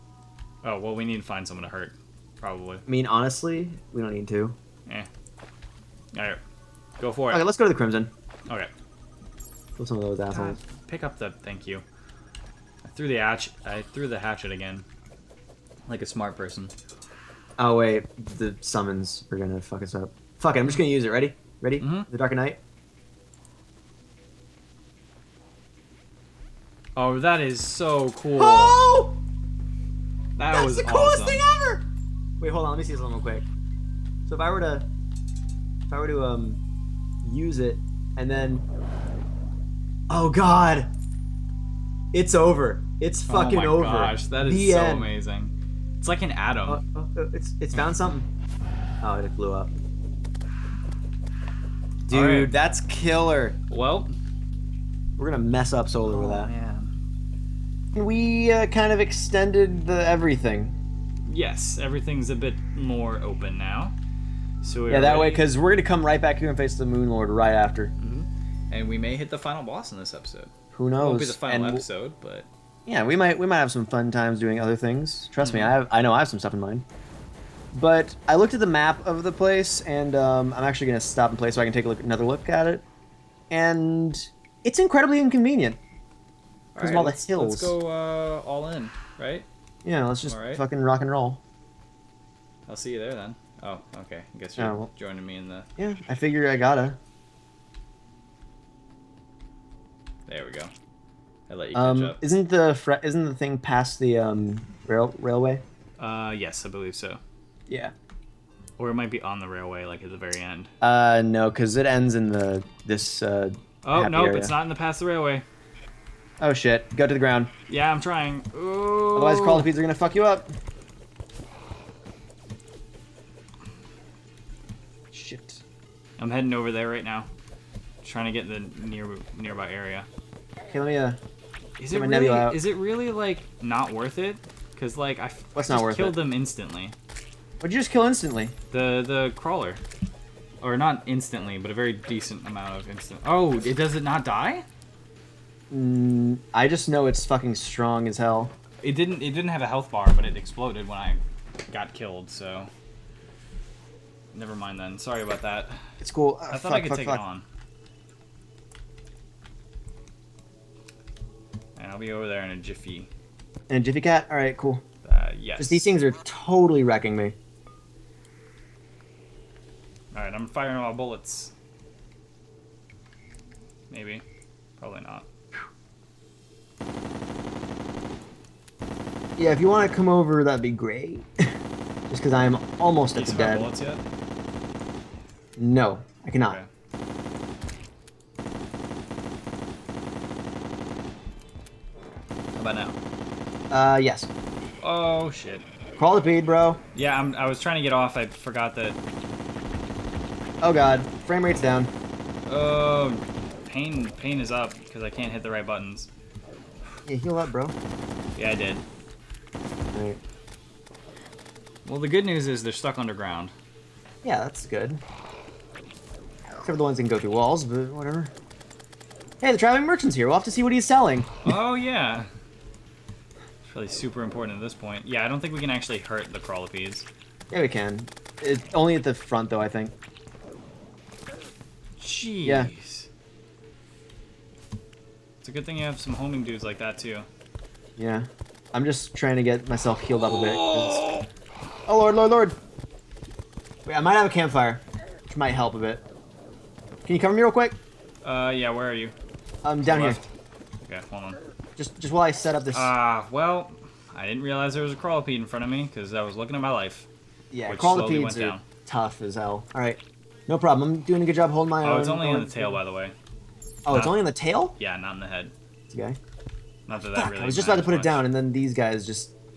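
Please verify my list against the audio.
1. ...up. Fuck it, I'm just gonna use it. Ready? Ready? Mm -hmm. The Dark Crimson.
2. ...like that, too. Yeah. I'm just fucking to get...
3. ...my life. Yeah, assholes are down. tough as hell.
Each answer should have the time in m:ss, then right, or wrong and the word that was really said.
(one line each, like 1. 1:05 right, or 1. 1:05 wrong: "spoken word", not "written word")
1. 0:19 wrong: "Knight", not "Crimson"
2. 3:56 wrong: "trying", not "fucking"
3. 4:16 wrong: "crawltipedes", not "assholes".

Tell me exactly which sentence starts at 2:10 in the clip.
Okay, let me uh Is it really is it really like not worth it?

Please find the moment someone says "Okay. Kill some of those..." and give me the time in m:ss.
0:08.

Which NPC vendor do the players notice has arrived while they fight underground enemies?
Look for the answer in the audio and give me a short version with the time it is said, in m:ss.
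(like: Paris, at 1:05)
Traveling merchant, at 3:39.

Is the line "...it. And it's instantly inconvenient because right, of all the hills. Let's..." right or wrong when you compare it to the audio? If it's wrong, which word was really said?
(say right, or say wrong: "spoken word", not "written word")
wrong: "incredibly", not "instantly".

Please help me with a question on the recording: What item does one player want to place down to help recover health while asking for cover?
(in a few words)
Campfire.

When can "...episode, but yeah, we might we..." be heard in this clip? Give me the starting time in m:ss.
1:11.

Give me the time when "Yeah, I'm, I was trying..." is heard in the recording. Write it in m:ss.
3:16.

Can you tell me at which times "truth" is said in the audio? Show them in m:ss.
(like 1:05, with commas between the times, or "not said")
not said.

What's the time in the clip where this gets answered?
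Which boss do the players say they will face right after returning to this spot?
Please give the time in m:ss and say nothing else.
1:06.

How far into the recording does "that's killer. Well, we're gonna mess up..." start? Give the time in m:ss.
0:52.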